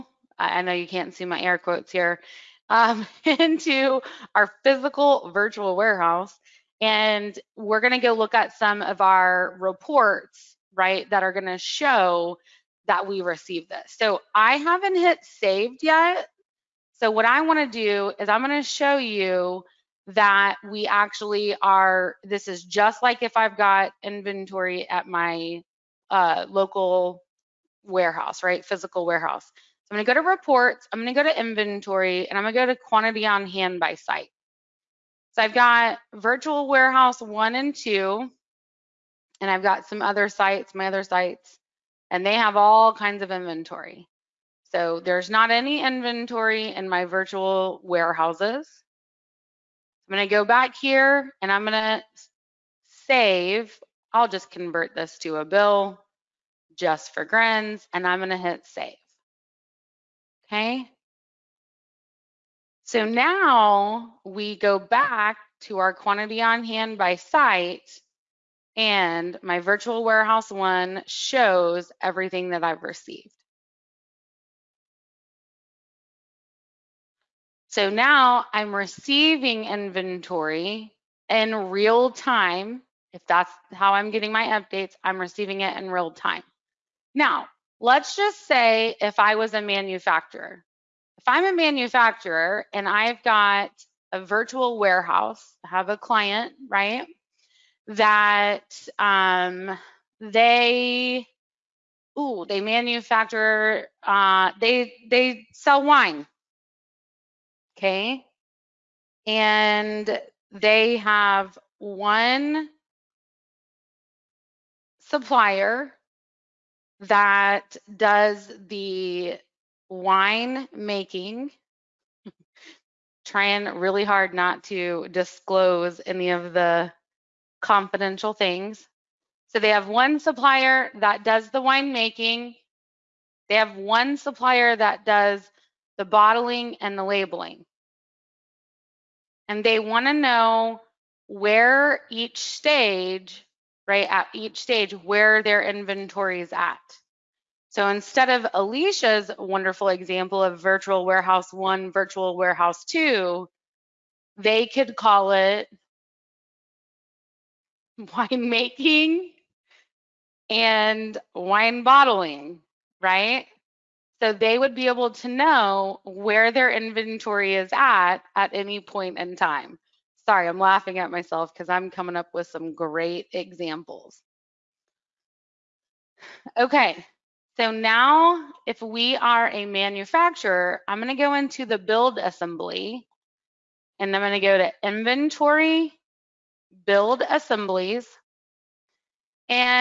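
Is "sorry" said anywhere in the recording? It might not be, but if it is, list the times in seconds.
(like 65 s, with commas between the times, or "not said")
170 s.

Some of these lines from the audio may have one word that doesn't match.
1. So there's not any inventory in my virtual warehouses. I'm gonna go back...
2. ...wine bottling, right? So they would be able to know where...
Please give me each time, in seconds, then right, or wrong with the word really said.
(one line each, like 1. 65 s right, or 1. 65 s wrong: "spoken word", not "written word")
1. 44 s right
2. 161 s right.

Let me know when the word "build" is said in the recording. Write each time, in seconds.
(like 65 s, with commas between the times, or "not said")
181 s, 186 s.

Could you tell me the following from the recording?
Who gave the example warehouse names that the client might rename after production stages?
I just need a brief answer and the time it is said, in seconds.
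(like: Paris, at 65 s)
Alisha, at 148 s.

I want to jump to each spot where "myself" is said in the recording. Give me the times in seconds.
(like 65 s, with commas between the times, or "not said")
171 s.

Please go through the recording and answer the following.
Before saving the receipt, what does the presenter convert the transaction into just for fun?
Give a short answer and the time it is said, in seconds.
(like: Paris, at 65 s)
A bill, at 55 s.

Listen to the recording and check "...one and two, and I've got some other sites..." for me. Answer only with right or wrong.
right.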